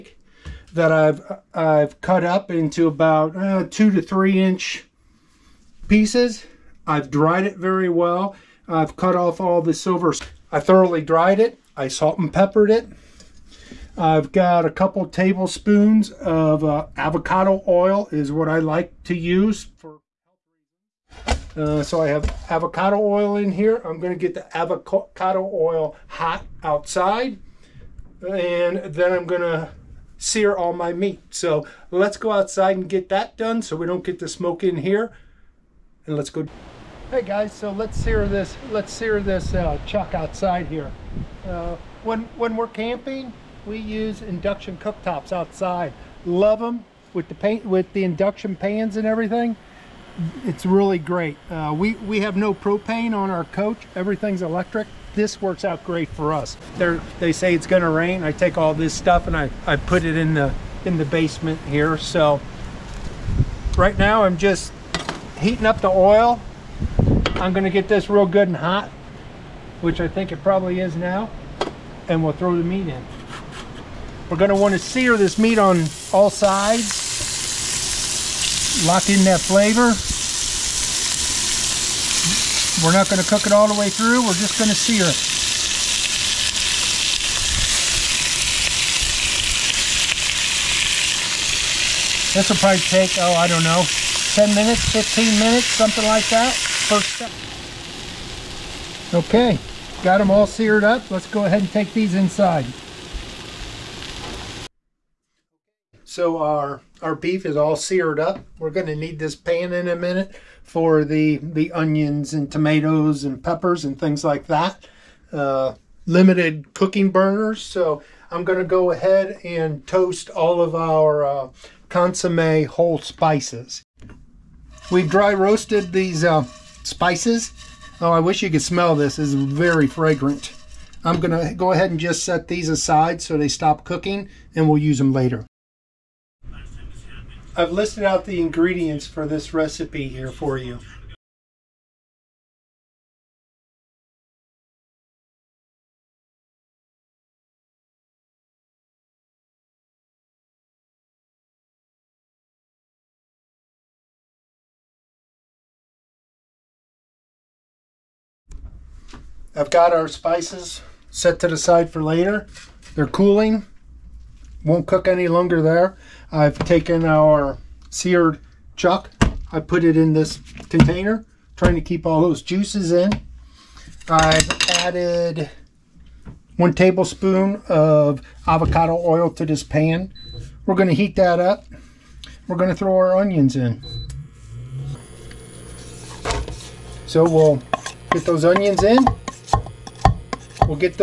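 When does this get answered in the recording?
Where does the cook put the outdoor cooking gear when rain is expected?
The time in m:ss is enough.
1:00.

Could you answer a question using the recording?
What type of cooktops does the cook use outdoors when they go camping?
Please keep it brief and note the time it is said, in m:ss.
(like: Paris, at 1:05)
induction cooktops, at 0:44.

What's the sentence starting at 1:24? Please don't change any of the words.
We're just going to sear it.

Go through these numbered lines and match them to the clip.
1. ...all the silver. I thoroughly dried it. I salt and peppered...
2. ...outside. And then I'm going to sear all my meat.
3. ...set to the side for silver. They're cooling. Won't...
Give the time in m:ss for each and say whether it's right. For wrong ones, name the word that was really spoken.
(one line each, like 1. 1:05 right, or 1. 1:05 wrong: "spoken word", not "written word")
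1. 0:09 right
2. 0:26 right
3. 2:41 wrong: "later", not "silver".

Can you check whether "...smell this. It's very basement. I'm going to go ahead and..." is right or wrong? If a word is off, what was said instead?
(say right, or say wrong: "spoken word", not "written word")
wrong: "fragrant", not "basement".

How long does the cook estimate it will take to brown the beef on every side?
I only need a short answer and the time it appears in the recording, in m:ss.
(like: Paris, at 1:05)
10 to 15 minutes, at 1:34.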